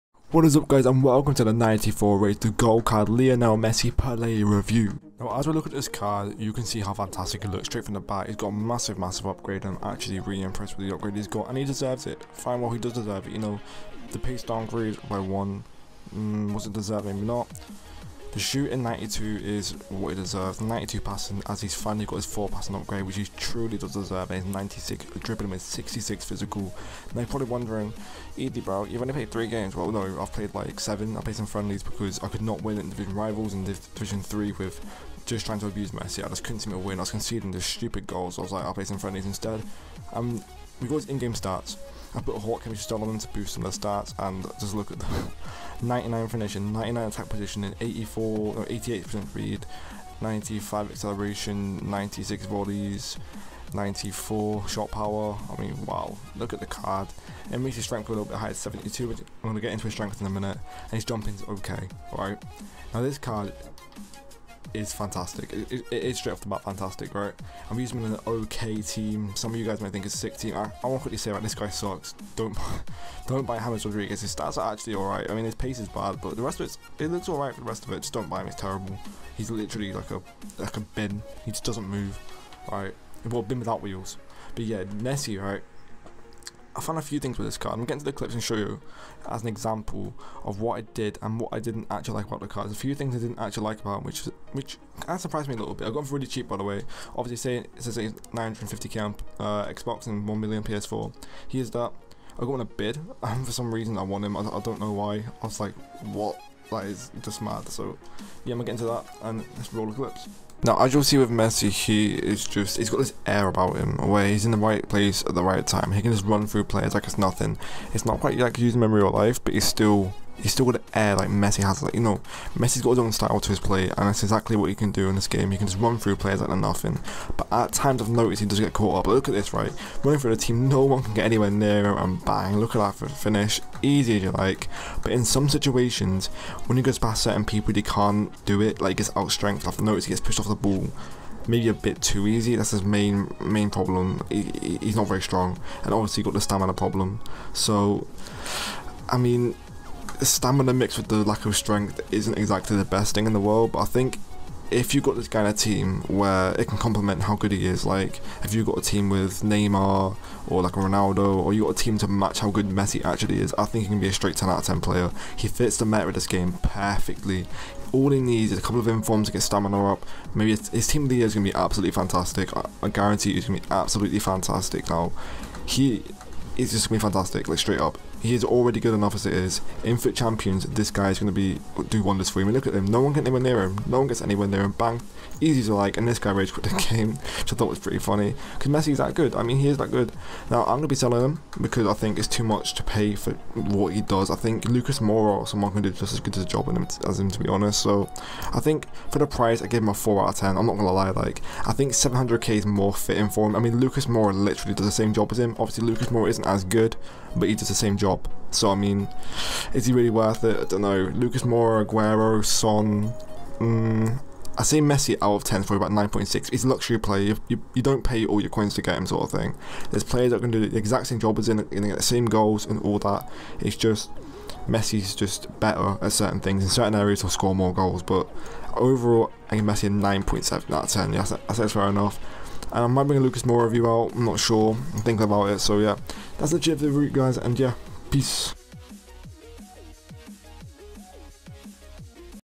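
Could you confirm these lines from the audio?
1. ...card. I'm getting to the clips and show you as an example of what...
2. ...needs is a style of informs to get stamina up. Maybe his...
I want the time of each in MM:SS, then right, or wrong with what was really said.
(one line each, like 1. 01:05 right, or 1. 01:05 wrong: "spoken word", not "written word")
1. 01:27 right
2. 02:48 wrong: "couple", not "style".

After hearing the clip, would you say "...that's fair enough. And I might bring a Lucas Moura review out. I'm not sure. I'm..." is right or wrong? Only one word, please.
right.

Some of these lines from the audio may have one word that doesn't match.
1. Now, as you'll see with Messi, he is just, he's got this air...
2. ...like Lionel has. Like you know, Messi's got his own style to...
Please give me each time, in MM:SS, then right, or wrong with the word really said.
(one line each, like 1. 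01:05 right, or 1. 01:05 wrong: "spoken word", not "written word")
1. 01:50 right
2. 02:01 wrong: "Messi", not "Lionel".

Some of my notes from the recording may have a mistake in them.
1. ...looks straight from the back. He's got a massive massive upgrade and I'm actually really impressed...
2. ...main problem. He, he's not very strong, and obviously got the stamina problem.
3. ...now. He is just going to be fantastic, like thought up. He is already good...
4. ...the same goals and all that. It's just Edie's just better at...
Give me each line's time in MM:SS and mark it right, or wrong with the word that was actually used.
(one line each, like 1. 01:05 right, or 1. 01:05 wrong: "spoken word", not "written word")
1. 00:07 right
2. 02:23 right
3. 02:54 wrong: "straight", not "thought"
4. 03:41 wrong: "Messi", not "Edie".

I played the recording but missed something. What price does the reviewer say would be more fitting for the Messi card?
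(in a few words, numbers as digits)
700k.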